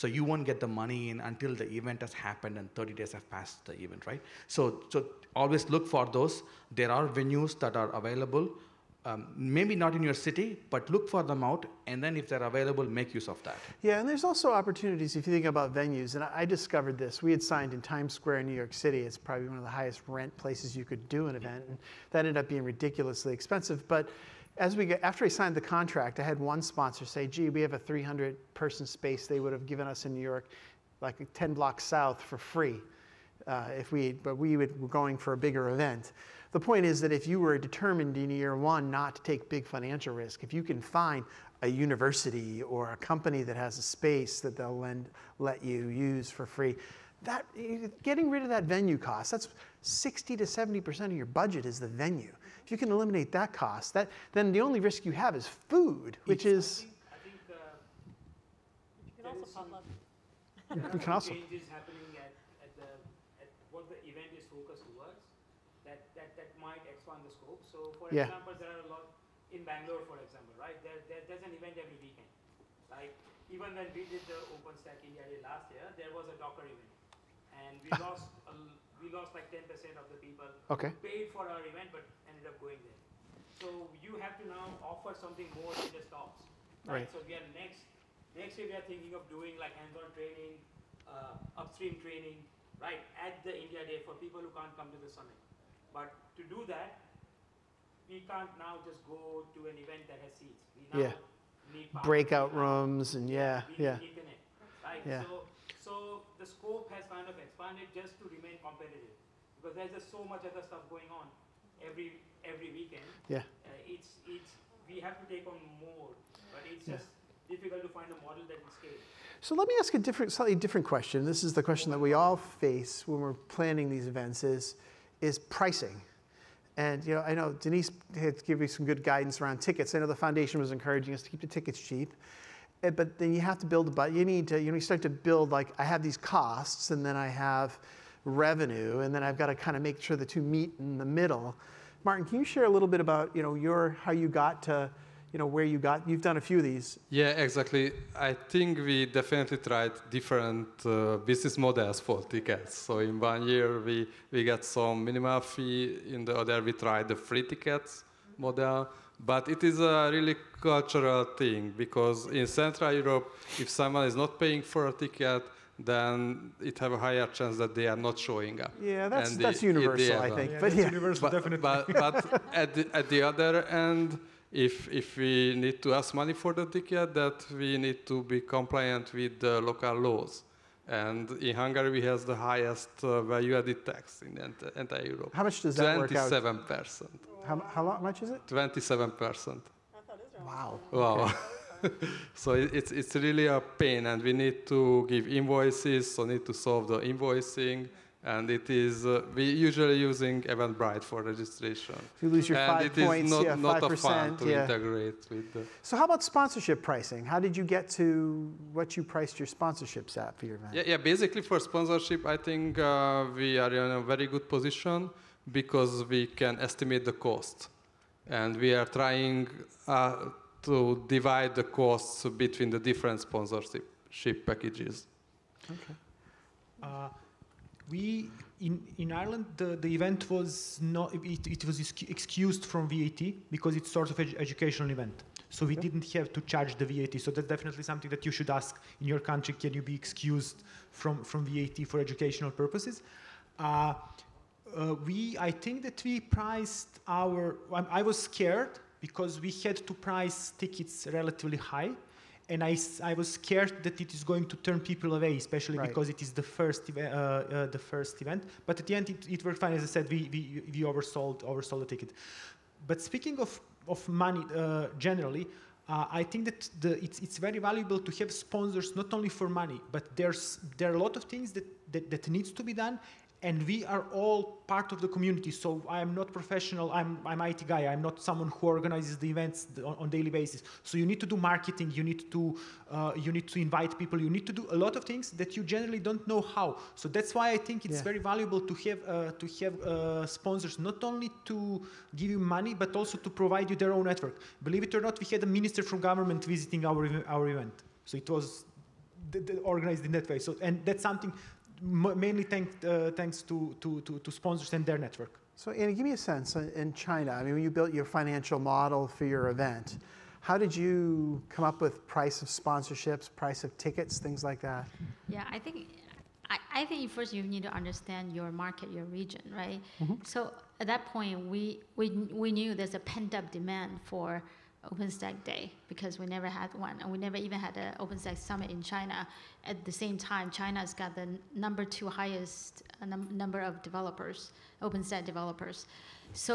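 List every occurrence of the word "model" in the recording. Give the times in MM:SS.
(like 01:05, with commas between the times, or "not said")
01:58, 02:31, 02:38, 05:08.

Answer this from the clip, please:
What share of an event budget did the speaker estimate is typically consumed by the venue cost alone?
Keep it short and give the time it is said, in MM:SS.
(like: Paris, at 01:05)
60 to 70%, at 00:49.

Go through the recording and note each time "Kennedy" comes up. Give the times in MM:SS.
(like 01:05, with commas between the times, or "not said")
not said.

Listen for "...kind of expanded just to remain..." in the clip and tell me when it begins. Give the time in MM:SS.
01:47.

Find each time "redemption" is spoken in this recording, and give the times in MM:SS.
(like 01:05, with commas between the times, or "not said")
not said.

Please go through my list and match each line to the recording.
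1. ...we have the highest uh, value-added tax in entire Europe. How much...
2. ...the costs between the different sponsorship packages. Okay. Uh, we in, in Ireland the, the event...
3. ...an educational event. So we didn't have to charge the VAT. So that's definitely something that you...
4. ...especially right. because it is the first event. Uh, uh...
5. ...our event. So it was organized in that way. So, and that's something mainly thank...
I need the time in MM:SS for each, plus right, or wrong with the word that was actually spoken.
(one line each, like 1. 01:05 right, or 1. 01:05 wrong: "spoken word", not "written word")
1. 03:01 right
2. 03:41 right
3. 03:54 right
4. 04:15 right
5. 04:57 right.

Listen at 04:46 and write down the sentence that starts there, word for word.
So that's why I think it's yeah.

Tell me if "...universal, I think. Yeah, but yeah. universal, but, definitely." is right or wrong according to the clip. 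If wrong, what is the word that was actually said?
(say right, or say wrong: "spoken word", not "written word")
right.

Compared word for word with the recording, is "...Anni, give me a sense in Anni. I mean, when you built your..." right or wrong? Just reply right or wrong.
wrong.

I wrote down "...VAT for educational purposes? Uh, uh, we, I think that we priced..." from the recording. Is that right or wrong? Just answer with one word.
right.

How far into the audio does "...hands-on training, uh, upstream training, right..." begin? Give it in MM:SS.
01:29.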